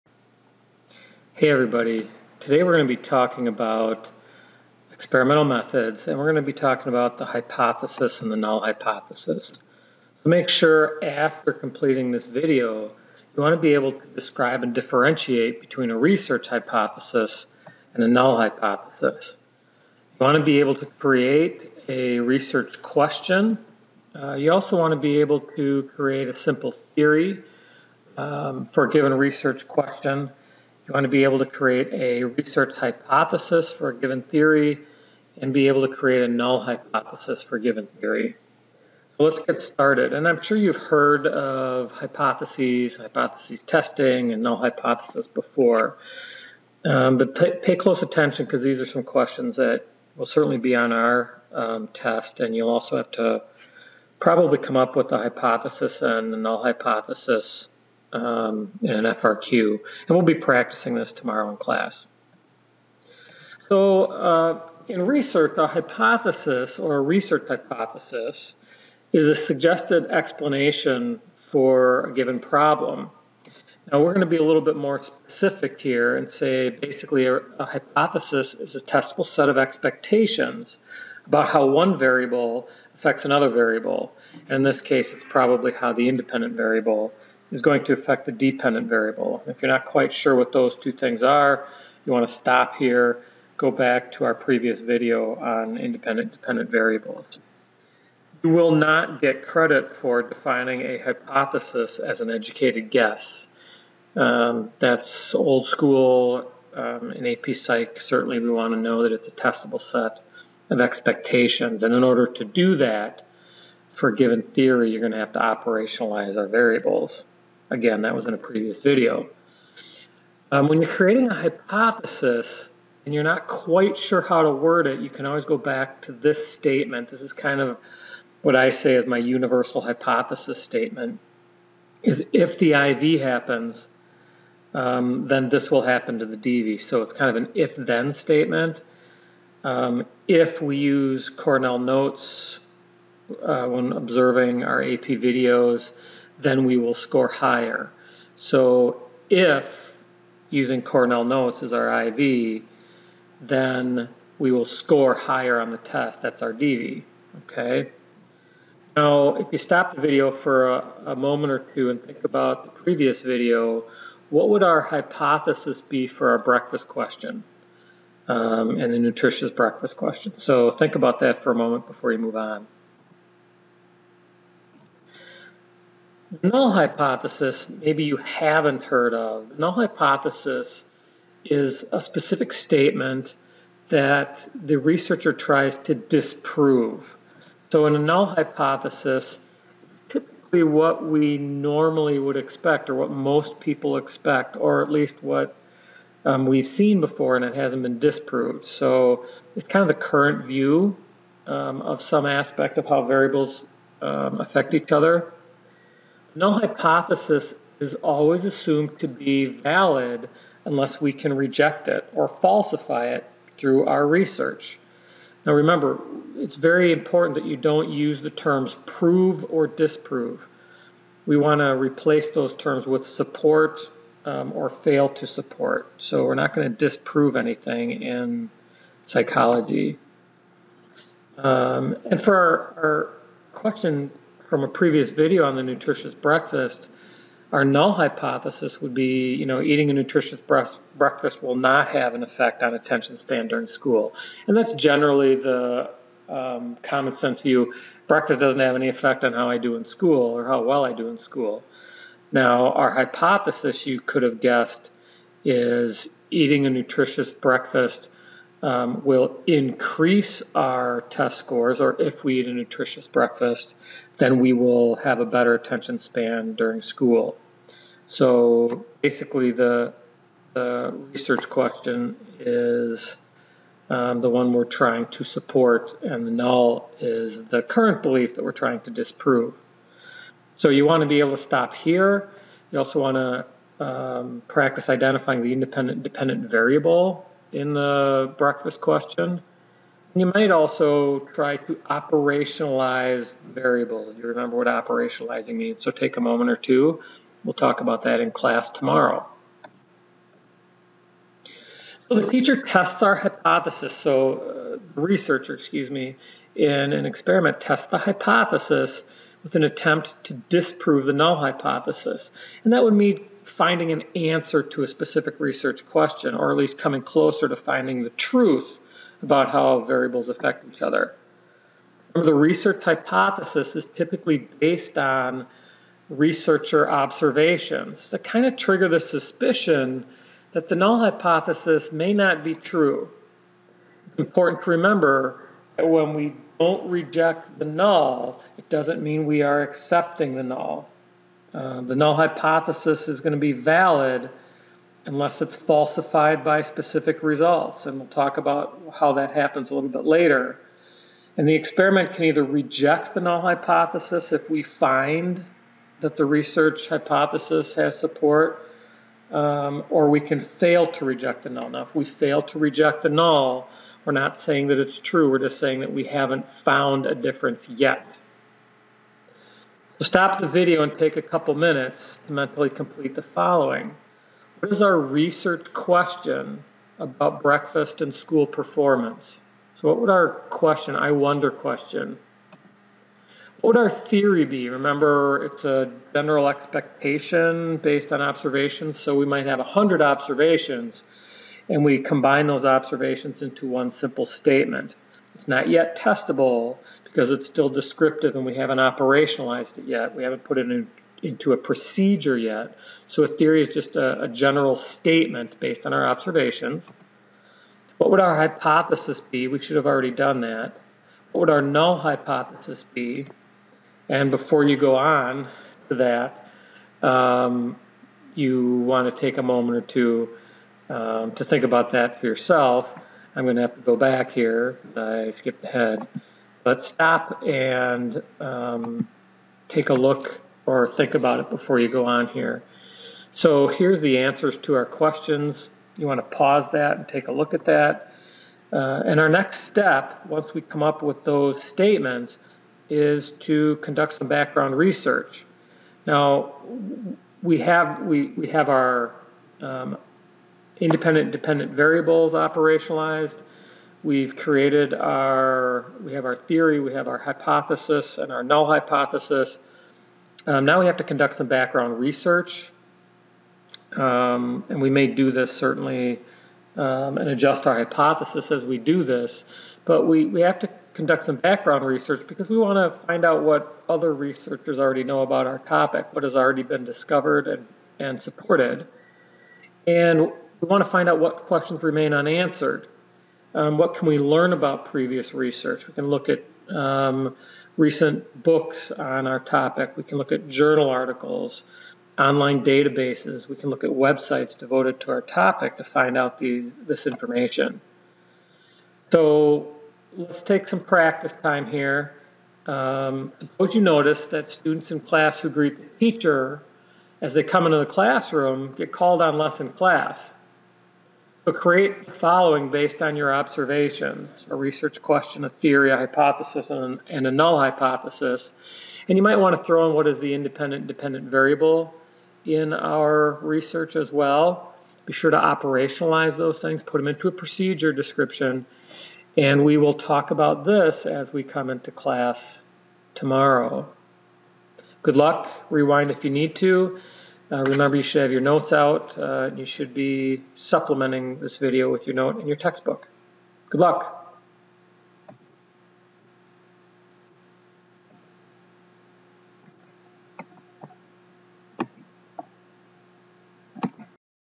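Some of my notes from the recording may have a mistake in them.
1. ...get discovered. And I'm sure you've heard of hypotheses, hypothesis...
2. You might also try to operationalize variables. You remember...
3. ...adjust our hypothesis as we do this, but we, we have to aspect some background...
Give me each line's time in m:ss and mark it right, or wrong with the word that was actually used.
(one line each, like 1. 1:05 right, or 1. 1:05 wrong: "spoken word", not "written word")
1. 0:39 wrong: "started", not "discovered"
2. 4:50 right
3. 7:47 wrong: "conduct", not "aspect".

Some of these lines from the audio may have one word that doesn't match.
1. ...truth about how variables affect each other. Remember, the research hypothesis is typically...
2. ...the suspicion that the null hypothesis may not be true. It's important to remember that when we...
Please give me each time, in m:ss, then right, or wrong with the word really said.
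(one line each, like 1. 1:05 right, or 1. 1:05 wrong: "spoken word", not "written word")
1. 5:18 right
2. 5:28 right.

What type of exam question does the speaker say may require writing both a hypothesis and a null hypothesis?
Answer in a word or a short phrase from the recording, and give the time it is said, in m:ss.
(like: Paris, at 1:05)
FRQ, at 0:59.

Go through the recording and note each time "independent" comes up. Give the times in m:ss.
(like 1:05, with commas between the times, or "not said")
1:26, 1:35, 4:45, 7:30, 8:40.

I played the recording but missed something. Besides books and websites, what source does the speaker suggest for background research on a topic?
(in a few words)
journal articles.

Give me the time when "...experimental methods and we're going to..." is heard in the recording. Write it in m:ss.
0:04.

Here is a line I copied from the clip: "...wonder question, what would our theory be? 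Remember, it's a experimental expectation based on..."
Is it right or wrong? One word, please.
wrong.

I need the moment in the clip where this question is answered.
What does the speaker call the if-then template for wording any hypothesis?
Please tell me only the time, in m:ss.
2:09.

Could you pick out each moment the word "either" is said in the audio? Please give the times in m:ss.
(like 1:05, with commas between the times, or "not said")
5:52.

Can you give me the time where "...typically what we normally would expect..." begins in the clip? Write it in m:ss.
3:10.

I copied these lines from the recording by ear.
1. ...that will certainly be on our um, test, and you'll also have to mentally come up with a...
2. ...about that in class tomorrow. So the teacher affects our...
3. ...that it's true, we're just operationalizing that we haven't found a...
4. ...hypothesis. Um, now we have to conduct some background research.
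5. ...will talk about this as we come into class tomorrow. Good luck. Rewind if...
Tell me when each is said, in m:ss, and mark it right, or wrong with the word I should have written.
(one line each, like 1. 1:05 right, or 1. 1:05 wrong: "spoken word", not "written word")
1. 0:49 wrong: "probably", not "mentally"
2. 4:57 wrong: "tests", not "affects"
3. 6:04 wrong: "saying", not "operationalizing"
4. 7:38 right
5. 8:49 right.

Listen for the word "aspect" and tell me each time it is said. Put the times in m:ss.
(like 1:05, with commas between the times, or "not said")
3:22.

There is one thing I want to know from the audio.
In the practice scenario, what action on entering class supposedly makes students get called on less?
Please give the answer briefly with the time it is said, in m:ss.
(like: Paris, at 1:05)
greet the teacher, at 8:25.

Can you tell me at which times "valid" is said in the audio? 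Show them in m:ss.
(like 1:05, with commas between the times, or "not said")
3:29, 5:43.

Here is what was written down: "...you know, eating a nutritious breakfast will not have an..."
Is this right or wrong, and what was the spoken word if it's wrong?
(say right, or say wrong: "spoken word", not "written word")
right.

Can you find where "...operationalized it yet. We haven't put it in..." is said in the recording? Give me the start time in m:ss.
6:38.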